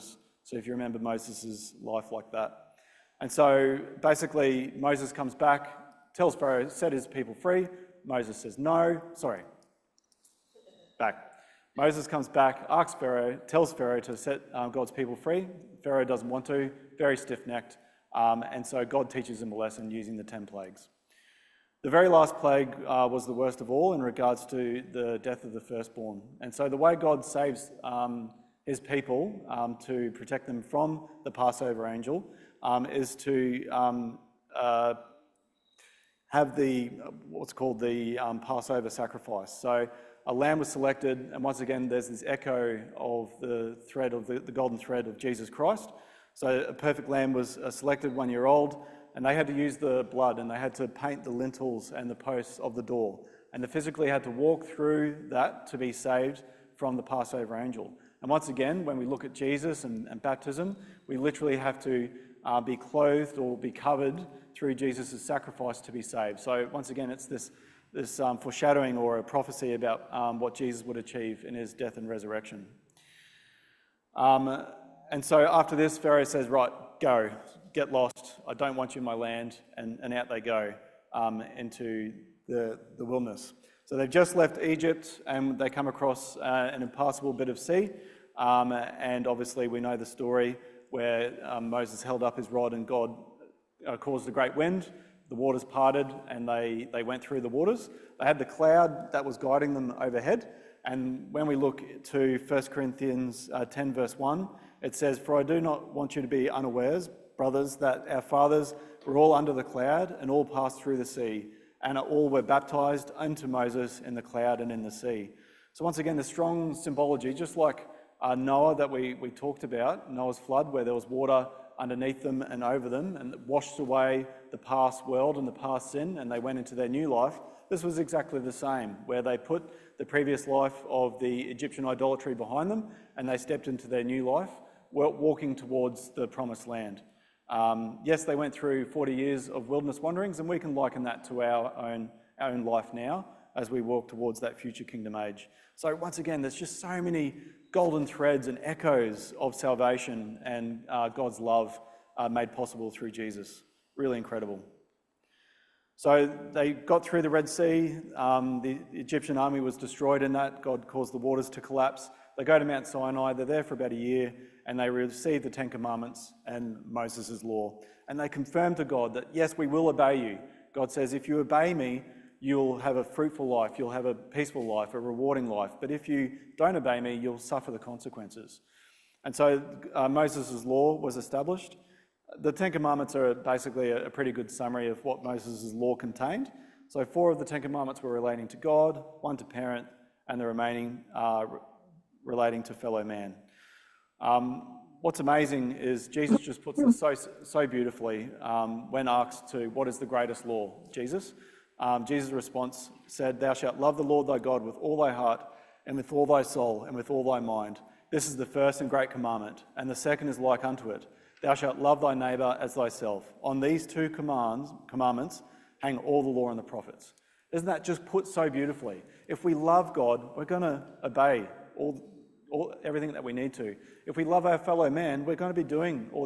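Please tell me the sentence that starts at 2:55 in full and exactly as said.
But if you don't obey me, you'll suffer the consequences.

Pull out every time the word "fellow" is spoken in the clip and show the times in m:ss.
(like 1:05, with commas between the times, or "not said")
3:12, 3:44.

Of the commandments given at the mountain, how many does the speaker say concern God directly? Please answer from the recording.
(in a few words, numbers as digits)
4.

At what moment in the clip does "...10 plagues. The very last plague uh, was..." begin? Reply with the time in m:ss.
0:20.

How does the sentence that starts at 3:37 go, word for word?
Isn't that just put so beautifully?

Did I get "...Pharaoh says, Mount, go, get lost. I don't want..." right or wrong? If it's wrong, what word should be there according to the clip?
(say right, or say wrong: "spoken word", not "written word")
wrong: "Right", not "Mount".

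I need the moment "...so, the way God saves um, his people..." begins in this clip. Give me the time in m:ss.
0:26.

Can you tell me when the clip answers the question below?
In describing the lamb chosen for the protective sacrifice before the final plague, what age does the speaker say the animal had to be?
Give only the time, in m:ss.
0:48.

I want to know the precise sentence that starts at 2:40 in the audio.
God caused the waters to collapse.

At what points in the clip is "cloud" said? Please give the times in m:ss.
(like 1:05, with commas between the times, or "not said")
1:38, 1:49, 1:54.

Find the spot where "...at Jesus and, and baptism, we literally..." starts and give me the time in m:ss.
0:59.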